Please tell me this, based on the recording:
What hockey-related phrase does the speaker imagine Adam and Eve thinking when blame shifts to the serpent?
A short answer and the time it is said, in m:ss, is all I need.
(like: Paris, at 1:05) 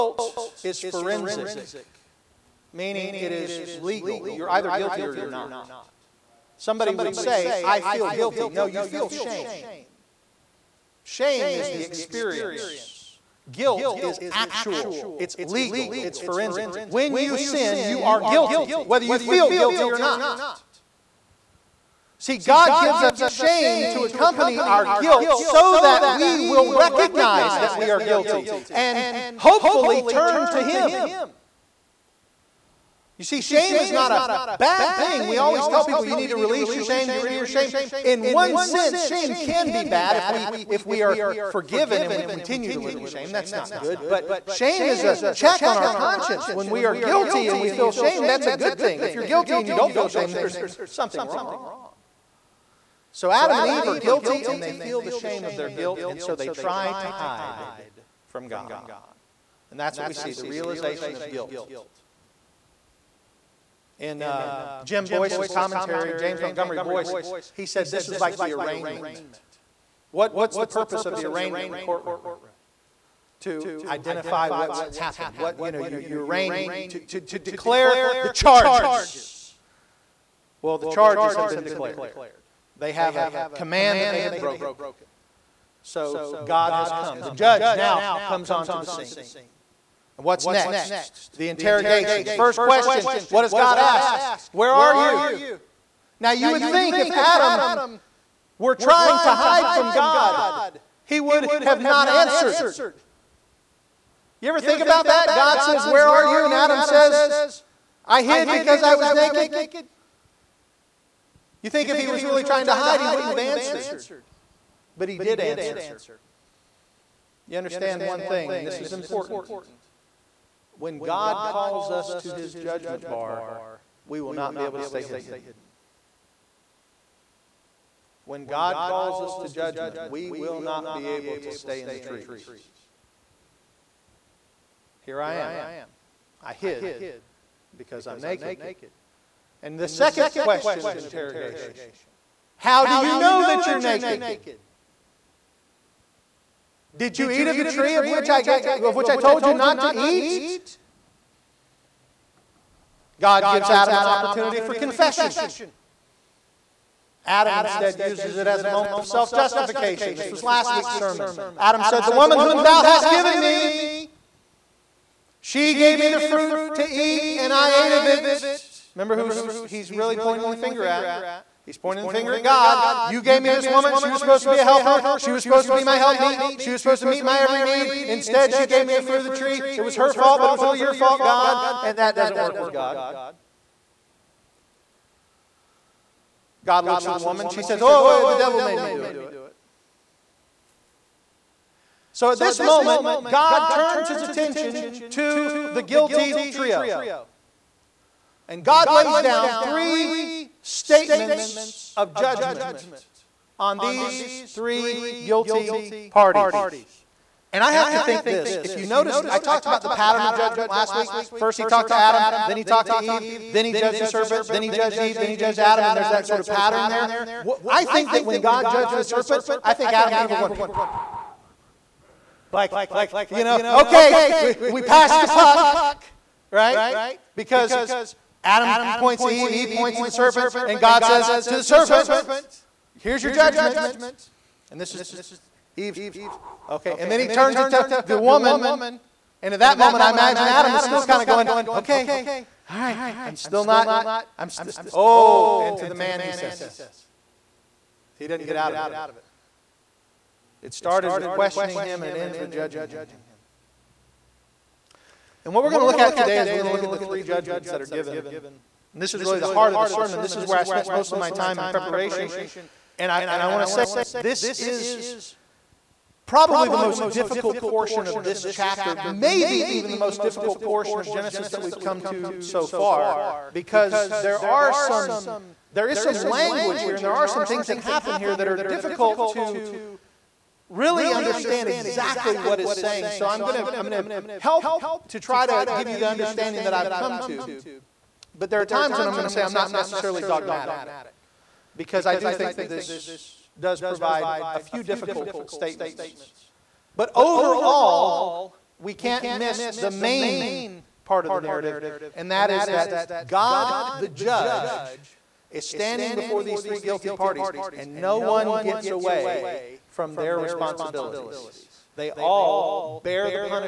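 Passed the puck, at 3:44.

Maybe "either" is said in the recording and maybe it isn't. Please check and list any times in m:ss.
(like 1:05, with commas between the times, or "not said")
0:04.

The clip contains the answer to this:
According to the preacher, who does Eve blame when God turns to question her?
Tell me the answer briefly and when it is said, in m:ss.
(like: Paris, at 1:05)
The devil, at 3:08.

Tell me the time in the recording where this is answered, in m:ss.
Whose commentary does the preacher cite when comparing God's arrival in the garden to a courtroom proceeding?
1:06.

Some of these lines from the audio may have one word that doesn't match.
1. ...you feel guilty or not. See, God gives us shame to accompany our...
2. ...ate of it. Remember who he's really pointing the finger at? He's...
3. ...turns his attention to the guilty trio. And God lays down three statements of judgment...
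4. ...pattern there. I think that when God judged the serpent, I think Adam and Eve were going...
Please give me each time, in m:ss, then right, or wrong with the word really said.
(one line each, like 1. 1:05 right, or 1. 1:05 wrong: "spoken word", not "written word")
1. 0:19 right
2. 2:47 right
3. 3:13 right
4. 3:36 right.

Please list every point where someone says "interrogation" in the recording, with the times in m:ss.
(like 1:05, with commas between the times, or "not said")
1:31, 2:20.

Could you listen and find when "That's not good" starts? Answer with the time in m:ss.
0:43.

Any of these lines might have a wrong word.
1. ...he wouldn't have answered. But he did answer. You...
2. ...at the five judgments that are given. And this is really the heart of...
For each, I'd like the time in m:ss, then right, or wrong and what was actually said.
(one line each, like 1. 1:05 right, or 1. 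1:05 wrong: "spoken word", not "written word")
1. 1:53 right
2. 4:16 wrong: "three", not "five".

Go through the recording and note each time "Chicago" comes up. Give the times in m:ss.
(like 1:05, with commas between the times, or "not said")
not said.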